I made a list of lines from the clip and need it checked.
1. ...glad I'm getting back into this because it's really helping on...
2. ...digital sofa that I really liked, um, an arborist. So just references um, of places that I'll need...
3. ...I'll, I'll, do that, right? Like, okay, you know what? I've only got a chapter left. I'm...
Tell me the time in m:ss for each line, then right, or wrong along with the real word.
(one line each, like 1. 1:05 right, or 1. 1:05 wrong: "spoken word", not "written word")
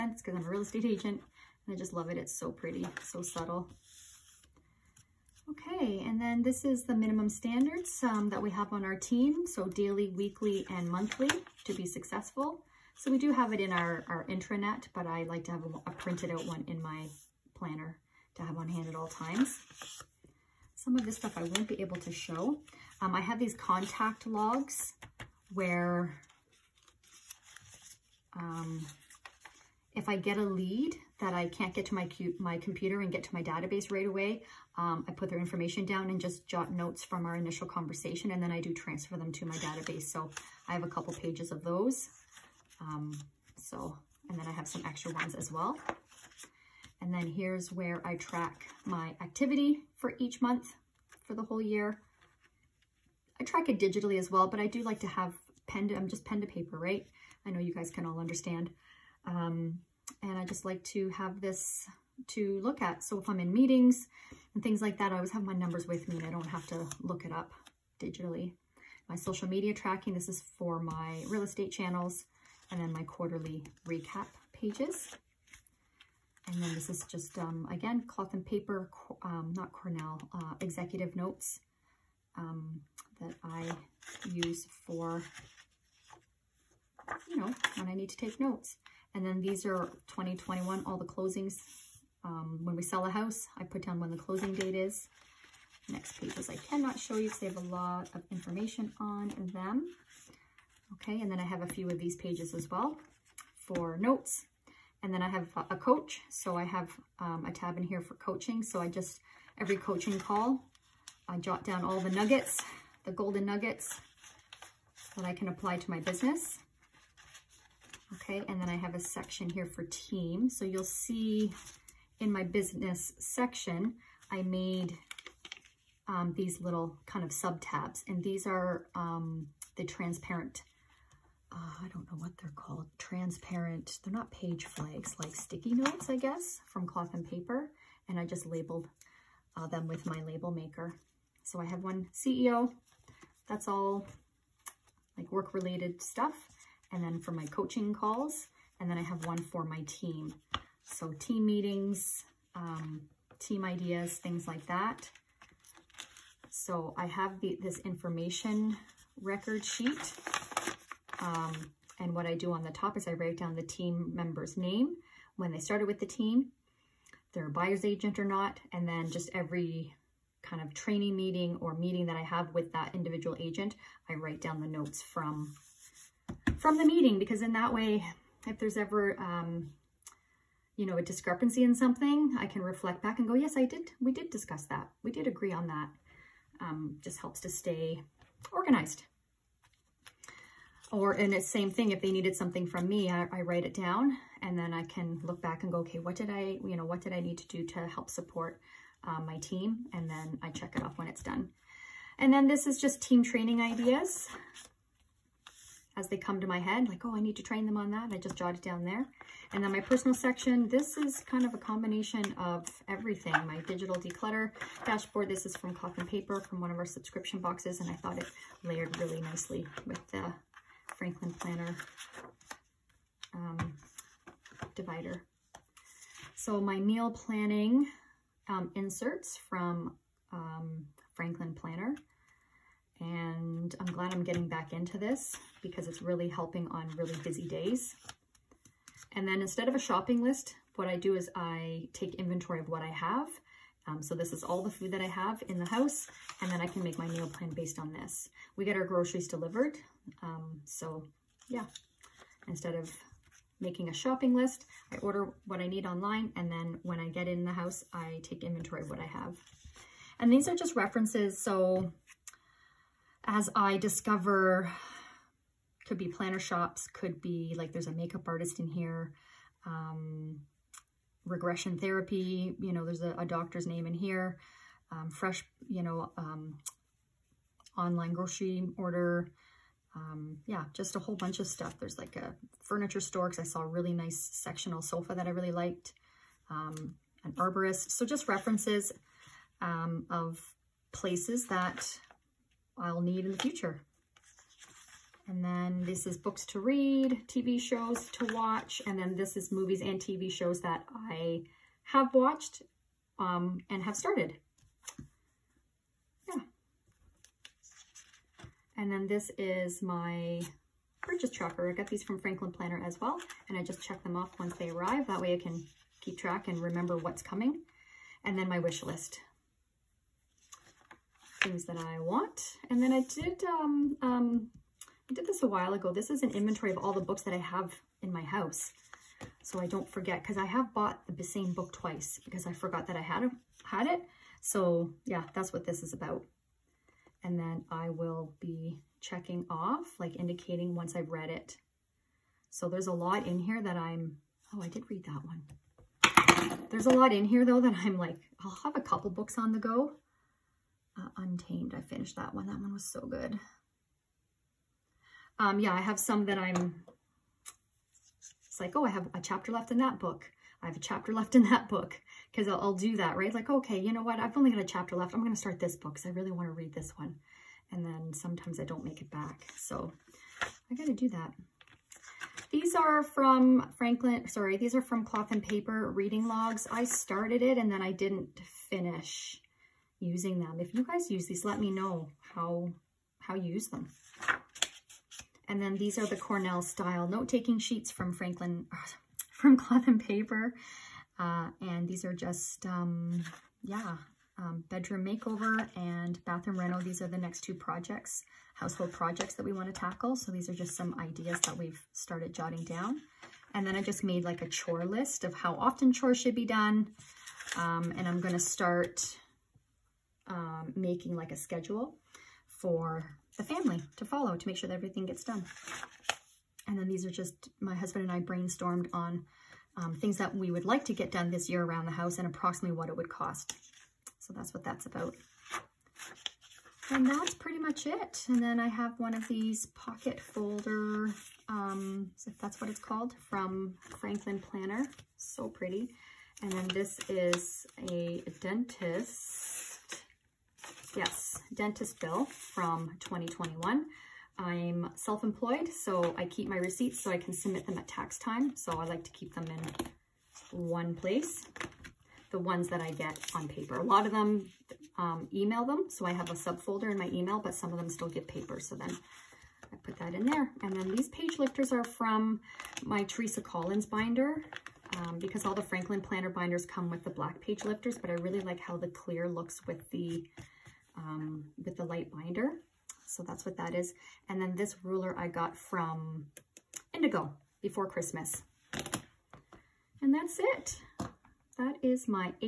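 1. 3:53 right
2. 4:44 wrong: "sectional", not "digital"
3. 6:02 right.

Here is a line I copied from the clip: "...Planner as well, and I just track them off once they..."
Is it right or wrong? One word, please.
wrong.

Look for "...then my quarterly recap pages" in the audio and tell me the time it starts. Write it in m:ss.
1:12.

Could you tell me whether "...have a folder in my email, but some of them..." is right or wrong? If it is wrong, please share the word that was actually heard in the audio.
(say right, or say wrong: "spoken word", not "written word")
wrong: "subfolder", not "folder".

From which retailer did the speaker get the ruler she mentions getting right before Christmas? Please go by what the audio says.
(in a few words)
Indigo.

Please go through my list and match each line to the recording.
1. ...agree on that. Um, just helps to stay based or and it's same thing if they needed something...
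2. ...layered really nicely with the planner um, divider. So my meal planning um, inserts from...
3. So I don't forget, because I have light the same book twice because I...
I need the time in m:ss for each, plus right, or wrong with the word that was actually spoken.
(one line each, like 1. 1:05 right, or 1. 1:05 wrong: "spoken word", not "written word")
1. 3:05 wrong: "organized", not "based"
2. 3:38 right
3. 5:29 wrong: "bought", not "light".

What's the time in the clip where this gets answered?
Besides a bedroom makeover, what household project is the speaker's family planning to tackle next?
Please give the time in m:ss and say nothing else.
6:36.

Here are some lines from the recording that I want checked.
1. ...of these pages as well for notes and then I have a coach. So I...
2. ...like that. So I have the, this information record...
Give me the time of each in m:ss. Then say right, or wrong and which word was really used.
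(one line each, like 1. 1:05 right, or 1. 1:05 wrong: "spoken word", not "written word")
1. 1:41 right
2. 2:34 right.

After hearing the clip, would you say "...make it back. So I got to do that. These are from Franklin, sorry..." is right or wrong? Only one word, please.
right.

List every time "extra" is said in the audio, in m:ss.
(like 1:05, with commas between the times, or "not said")
0:44.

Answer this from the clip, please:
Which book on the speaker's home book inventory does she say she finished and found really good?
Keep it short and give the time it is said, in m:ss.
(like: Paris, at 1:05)
Untamed, at 5:51.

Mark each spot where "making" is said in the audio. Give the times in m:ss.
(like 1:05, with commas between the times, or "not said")
4:13, 6:50.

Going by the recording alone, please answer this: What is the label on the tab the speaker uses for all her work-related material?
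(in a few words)
CEO.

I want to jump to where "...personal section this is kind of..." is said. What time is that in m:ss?
3:29.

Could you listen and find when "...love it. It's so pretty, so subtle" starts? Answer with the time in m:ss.
0:01.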